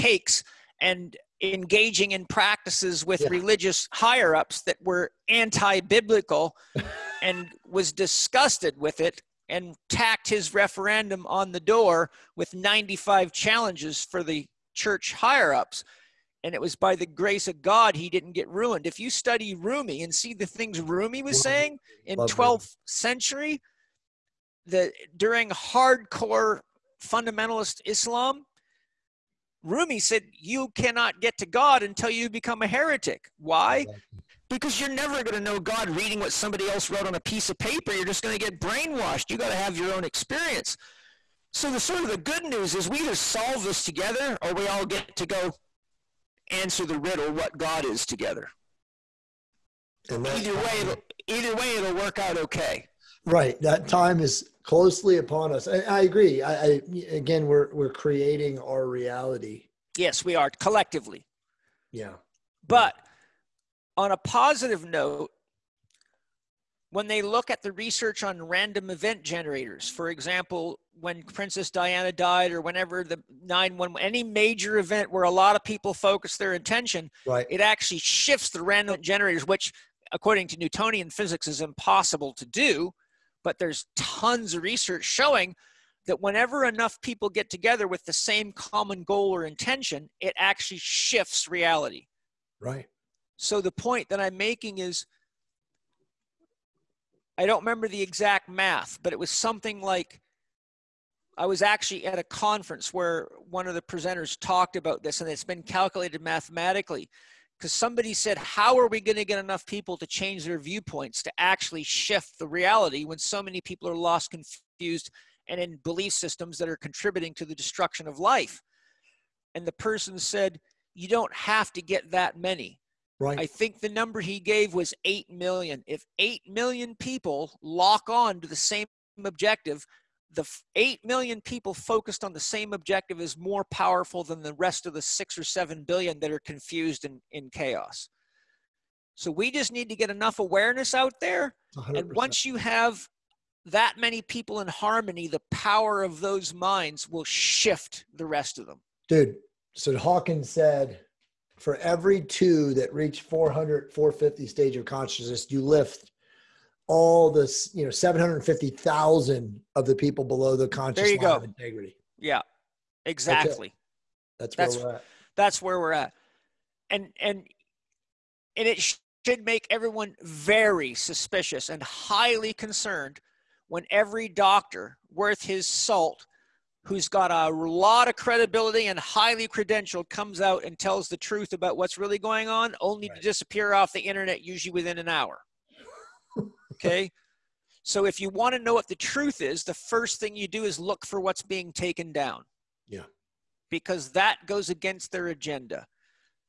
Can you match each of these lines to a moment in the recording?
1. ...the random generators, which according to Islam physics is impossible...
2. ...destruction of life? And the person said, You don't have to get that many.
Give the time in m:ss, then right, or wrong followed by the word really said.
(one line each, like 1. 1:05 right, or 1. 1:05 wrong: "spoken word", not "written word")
1. 1:18 wrong: "Newtonian", not "Islam"
2. 1:57 right.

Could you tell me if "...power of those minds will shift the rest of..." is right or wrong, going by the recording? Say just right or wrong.
right.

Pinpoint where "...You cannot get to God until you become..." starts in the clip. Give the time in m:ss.
0:30.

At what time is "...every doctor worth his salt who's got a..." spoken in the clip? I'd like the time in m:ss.
2:53.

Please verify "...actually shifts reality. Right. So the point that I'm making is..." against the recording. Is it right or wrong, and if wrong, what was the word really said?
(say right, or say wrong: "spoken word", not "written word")
right.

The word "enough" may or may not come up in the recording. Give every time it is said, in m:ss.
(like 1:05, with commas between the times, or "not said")
1:26, 1:49, 2:20.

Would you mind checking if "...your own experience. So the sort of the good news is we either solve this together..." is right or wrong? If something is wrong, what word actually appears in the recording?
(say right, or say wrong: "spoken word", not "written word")
right.